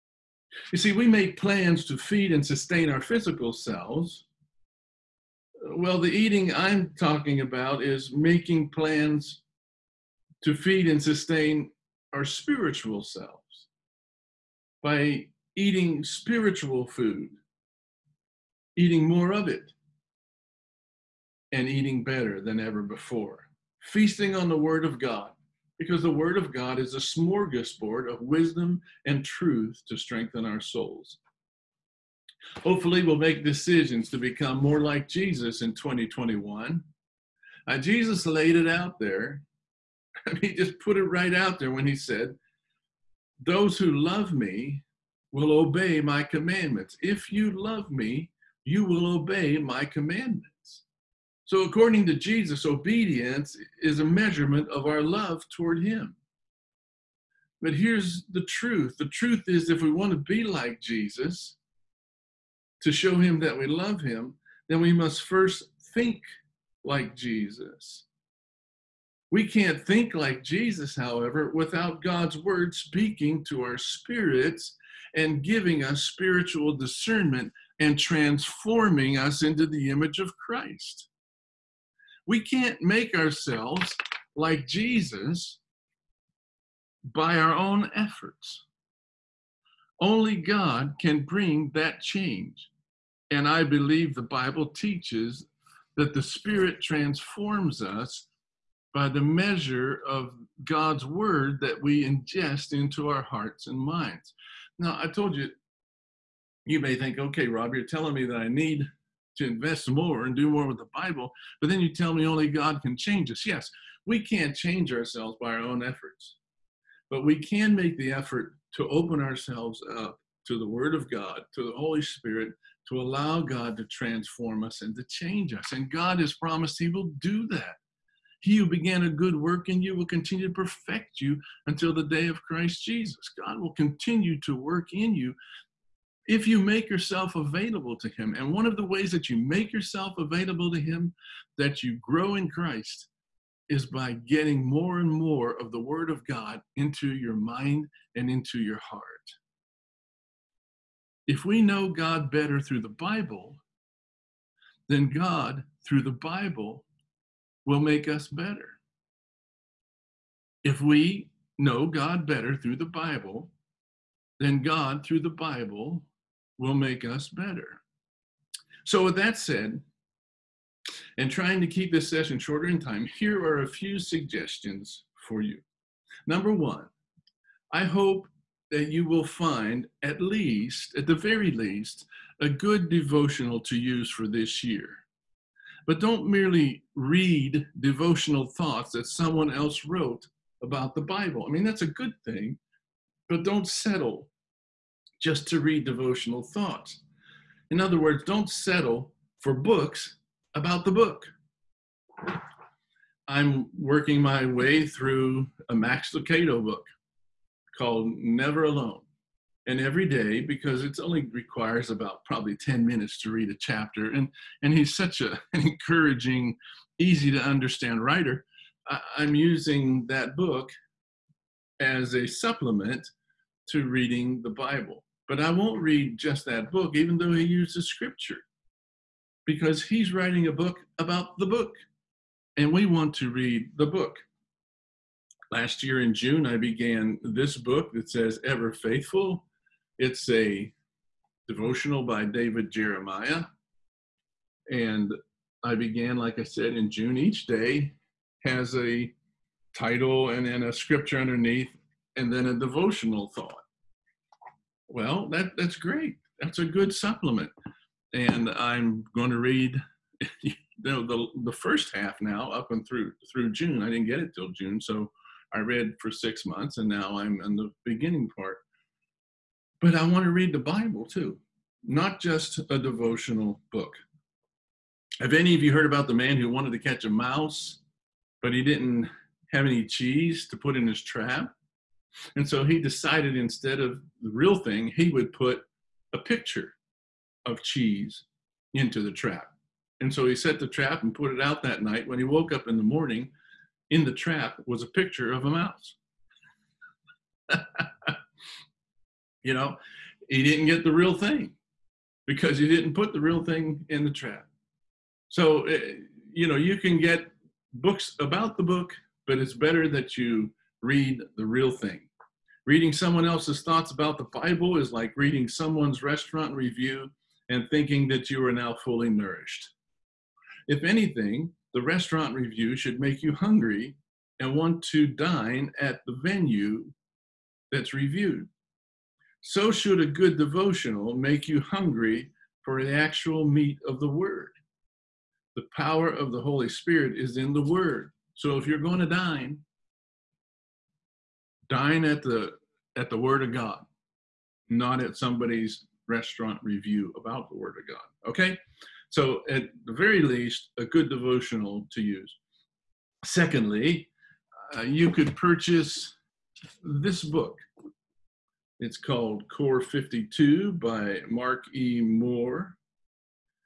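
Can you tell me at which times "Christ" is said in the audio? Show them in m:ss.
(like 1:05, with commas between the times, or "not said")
1:20, 2:12, 2:22.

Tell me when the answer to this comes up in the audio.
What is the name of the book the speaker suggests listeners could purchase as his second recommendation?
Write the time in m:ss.
5:59.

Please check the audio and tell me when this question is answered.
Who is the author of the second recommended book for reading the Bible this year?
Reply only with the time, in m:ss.
6:01.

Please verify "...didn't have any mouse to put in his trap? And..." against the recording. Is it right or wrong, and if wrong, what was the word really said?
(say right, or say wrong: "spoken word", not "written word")
wrong: "cheese", not "mouse".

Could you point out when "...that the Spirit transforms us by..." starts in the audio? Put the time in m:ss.
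1:35.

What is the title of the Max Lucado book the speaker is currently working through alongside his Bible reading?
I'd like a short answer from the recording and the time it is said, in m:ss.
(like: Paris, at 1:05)
Never Alone, at 3:28.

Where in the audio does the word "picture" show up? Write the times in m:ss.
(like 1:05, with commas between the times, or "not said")
4:46, 4:54.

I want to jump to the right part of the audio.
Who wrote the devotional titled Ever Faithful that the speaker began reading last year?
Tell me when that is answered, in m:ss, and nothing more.
4:02.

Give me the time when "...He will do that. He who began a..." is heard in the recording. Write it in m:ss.
2:06.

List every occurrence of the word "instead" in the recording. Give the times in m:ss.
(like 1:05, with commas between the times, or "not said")
4:43.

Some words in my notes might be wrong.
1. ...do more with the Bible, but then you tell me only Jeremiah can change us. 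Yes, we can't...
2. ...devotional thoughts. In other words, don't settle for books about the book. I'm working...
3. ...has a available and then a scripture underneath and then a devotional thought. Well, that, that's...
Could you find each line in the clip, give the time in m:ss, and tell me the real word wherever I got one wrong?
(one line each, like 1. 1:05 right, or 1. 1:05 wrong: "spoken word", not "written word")
1. 1:50 wrong: "God", not "Jeremiah"
2. 3:15 right
3. 4:08 wrong: "title", not "available".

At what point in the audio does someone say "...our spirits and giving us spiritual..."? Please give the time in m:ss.
1:13.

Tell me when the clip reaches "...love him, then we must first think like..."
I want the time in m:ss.
1:03.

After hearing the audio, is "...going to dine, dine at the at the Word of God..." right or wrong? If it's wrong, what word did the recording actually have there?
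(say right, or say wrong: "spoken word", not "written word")
right.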